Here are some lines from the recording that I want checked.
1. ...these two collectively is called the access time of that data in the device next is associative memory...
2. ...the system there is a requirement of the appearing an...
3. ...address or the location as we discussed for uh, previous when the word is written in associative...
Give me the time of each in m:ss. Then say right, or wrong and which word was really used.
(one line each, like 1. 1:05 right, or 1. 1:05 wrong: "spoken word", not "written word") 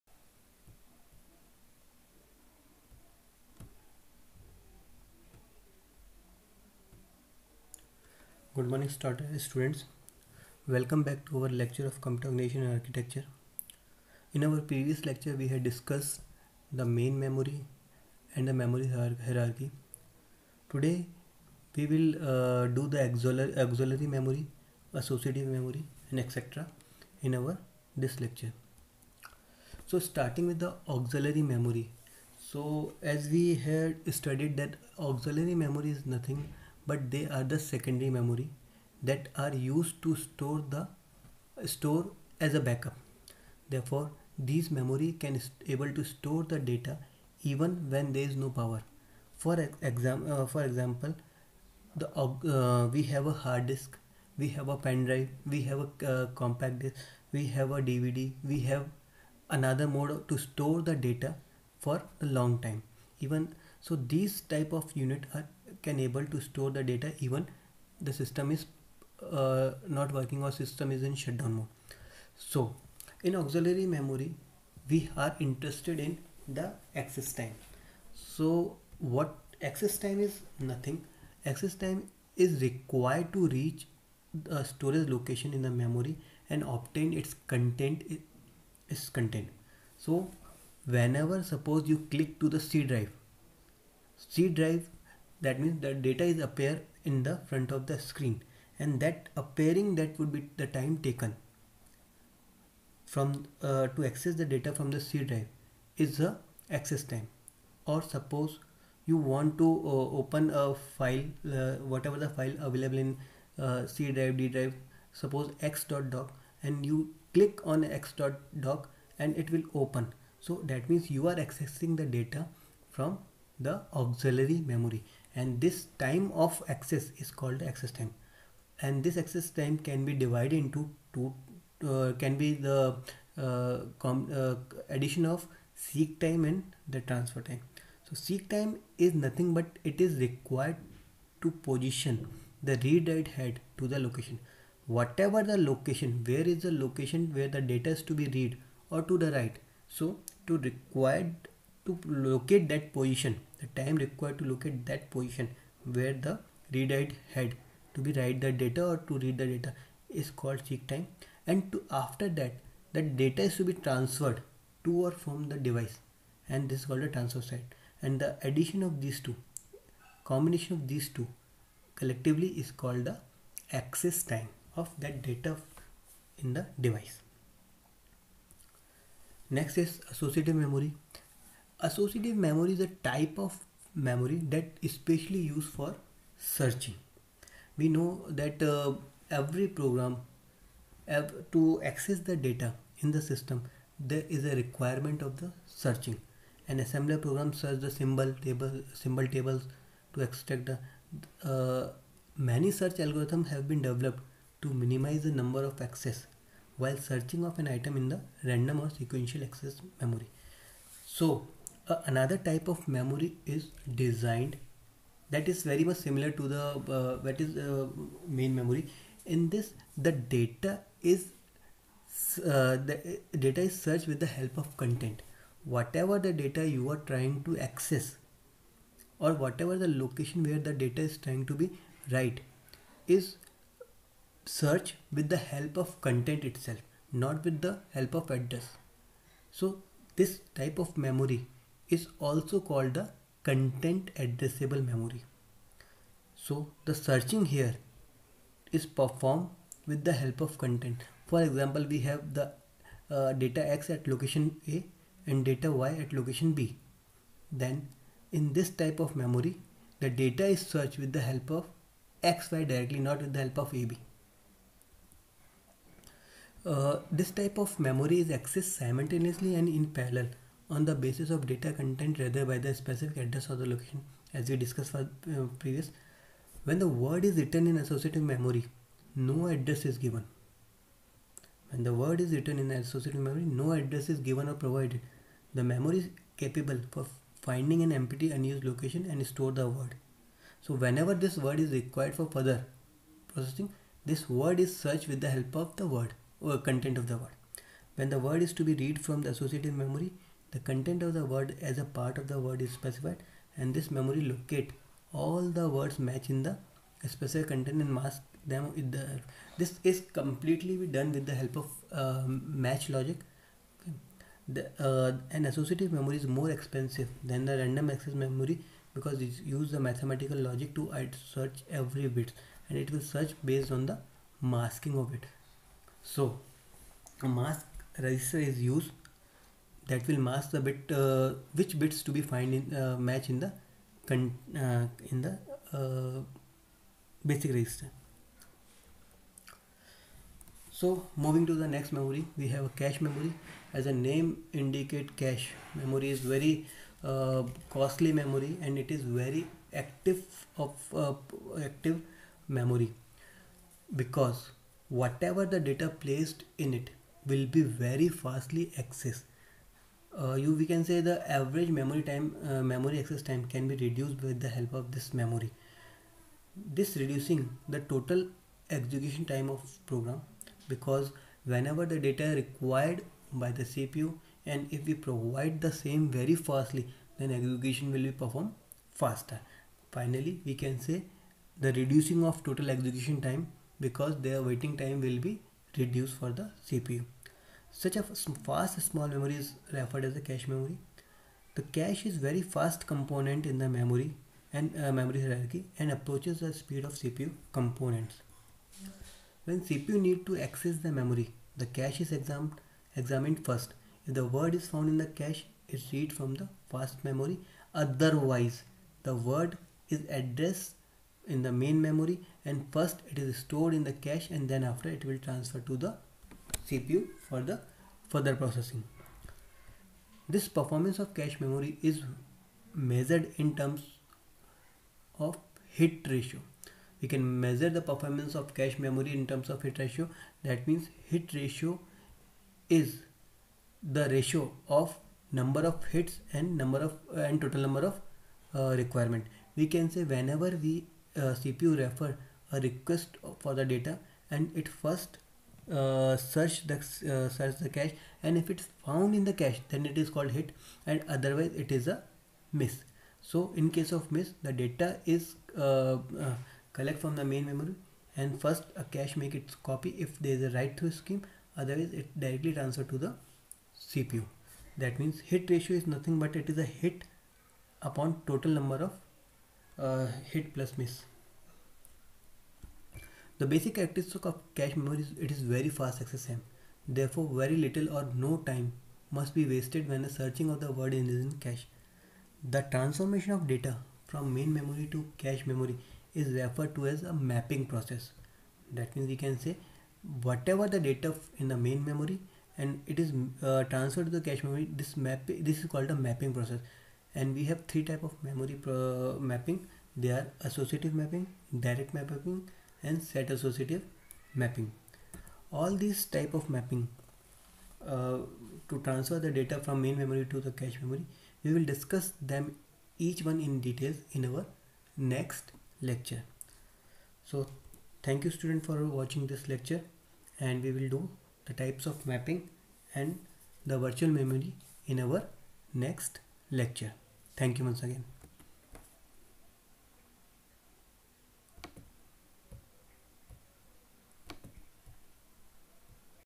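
1. 2:50 right
2. 3:13 wrong: "searching", not "appearing"
3. 4:33 right.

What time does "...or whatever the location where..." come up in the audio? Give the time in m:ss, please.
3:49.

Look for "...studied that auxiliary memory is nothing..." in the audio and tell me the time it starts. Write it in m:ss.
0:34.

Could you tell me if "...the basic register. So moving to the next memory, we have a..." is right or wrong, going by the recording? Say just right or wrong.
right.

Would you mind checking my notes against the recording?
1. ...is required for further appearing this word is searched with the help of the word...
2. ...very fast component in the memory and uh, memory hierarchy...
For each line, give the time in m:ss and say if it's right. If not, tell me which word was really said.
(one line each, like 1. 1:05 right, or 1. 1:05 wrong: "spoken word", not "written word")
1. 4:51 wrong: "processing", not "appearing"
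2. 6:32 right.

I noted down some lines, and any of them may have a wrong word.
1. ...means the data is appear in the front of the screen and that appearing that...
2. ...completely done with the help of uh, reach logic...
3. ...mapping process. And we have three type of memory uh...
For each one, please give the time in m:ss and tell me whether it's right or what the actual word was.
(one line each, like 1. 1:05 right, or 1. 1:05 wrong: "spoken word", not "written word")
1. 1:35 right
2. 5:10 wrong: "match", not "reach"
3. 8:16 right.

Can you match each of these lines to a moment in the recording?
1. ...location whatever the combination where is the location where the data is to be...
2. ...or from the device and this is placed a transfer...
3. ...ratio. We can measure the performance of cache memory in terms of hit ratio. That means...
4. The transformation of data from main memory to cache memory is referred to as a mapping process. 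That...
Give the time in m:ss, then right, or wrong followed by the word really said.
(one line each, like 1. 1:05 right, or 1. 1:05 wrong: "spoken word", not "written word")
1. 2:23 wrong: "location", not "combination"
2. 2:45 wrong: "called", not "placed"
3. 7:06 right
4. 8:02 right.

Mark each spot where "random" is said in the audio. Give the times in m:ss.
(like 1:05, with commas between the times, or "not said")
3:28, 5:17.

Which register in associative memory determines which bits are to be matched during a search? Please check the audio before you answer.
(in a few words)
Mask register.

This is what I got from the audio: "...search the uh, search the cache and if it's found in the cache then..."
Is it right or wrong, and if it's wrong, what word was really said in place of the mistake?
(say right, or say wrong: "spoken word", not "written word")
right.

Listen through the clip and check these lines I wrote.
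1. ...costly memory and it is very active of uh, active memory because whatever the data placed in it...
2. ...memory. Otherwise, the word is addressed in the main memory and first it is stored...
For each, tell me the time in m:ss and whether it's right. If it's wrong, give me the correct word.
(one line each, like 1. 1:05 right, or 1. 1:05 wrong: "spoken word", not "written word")
1. 5:47 right
2. 6:47 right.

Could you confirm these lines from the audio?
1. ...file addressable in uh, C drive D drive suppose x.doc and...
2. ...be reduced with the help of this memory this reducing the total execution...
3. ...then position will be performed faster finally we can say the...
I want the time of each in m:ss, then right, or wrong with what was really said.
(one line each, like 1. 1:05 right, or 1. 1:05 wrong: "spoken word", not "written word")
1. 1:52 wrong: "available", not "addressable"
2. 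6:03 right
3. 6:17 wrong: "execution", not "position".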